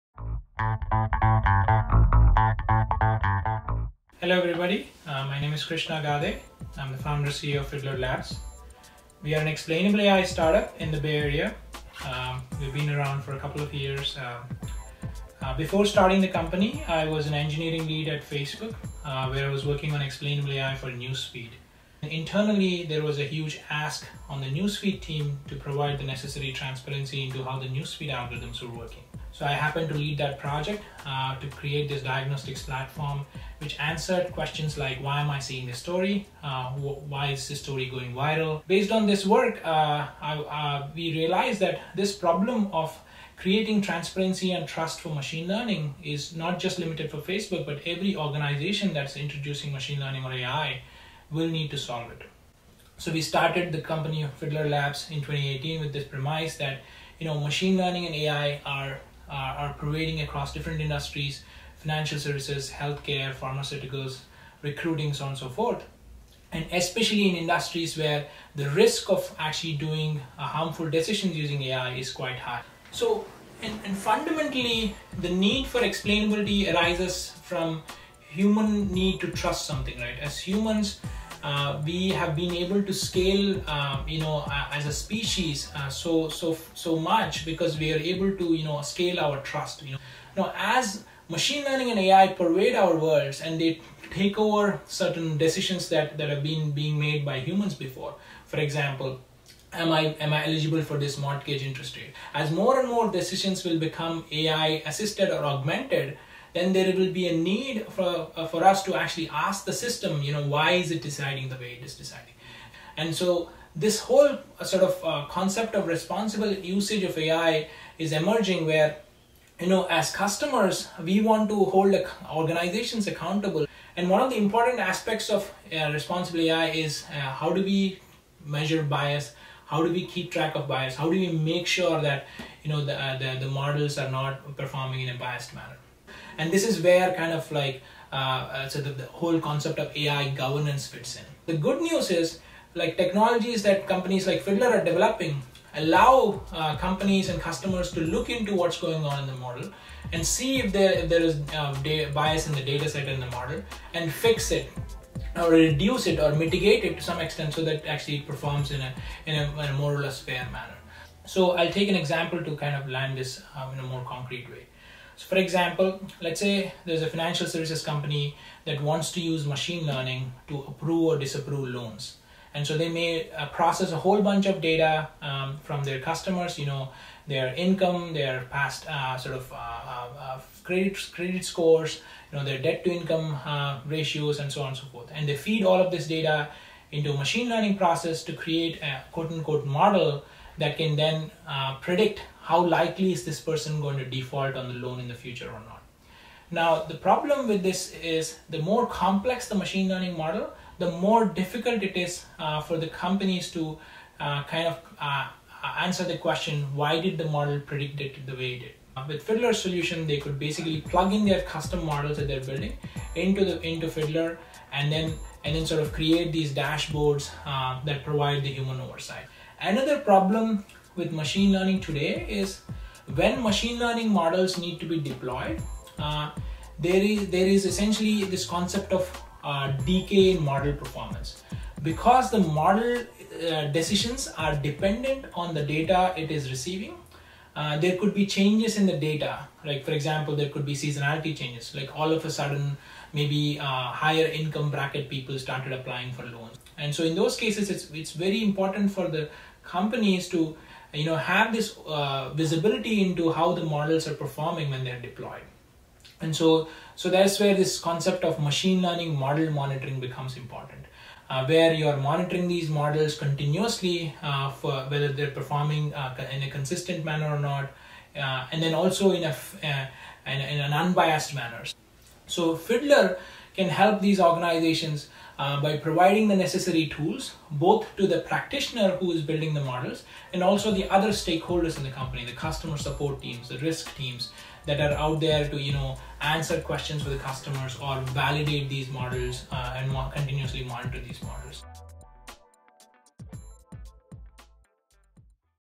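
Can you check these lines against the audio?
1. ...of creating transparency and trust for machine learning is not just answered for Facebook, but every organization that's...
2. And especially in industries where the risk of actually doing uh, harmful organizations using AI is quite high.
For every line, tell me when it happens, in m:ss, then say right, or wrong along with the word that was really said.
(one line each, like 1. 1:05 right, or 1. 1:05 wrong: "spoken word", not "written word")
1. 0:42 wrong: "limited", not "answered"
2. 1:06 wrong: "decisions", not "organizations".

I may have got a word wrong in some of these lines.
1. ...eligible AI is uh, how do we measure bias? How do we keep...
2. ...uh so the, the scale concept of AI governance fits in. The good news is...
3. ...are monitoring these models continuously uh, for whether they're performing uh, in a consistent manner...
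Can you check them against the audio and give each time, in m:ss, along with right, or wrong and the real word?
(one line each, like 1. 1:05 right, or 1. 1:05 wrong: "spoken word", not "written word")
1. 2:05 wrong: "responsible", not "eligible"
2. 2:18 wrong: "whole", not "scale"
3. 4:21 right.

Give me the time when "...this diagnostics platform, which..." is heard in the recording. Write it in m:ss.
0:31.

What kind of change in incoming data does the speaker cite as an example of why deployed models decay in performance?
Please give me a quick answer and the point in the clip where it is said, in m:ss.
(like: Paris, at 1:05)
Seasonality changes, at 4:00.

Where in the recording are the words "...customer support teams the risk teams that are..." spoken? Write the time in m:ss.
4:42.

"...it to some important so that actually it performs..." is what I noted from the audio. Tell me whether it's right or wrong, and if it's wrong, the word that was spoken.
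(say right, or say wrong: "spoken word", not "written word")
wrong: "extent", not "important".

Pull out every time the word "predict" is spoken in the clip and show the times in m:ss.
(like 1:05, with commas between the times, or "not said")
3:11, 3:27.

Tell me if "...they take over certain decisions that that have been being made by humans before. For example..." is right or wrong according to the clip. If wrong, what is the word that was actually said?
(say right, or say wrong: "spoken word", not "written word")
right.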